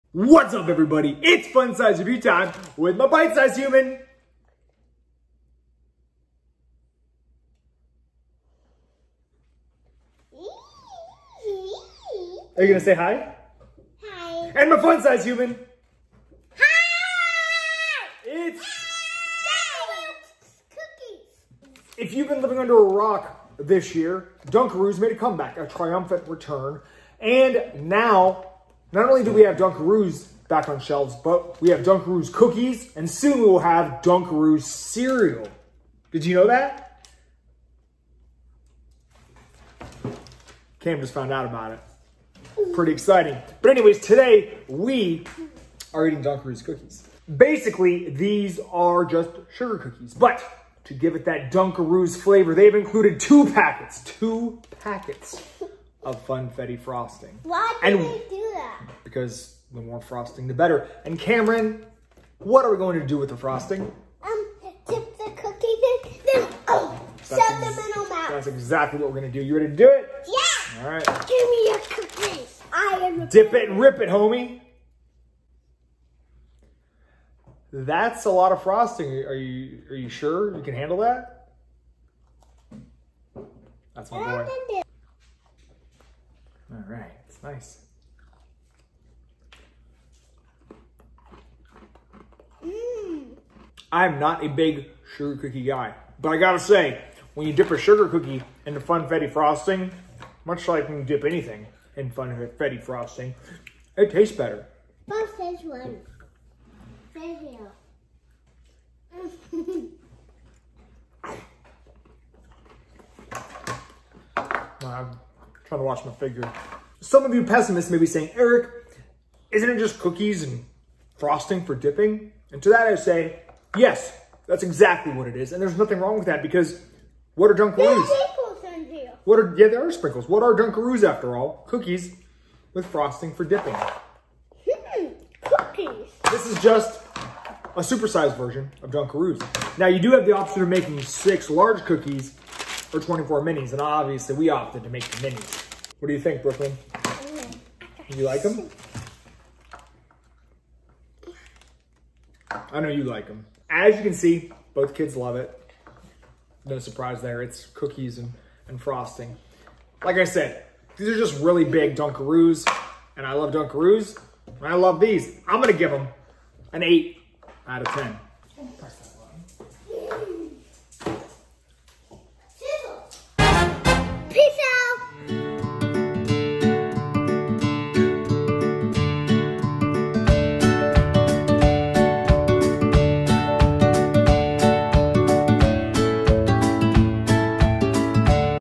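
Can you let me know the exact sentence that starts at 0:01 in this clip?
It's Fun Size Review Time with my Bite Size Human.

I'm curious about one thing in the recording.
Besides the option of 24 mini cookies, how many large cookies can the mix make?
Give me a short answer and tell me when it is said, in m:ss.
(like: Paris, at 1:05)
6, at 2:21.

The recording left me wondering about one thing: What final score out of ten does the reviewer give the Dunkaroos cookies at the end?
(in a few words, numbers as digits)
8.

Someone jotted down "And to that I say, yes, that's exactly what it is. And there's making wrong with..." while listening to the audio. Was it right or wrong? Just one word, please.
wrong.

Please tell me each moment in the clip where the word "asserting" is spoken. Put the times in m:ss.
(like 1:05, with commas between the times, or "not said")
not said.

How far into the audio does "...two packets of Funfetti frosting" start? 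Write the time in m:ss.
0:54.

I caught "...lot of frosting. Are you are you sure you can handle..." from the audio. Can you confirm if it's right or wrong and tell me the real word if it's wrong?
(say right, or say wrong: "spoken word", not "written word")
right.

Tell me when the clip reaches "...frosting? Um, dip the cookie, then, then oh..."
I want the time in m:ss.
1:03.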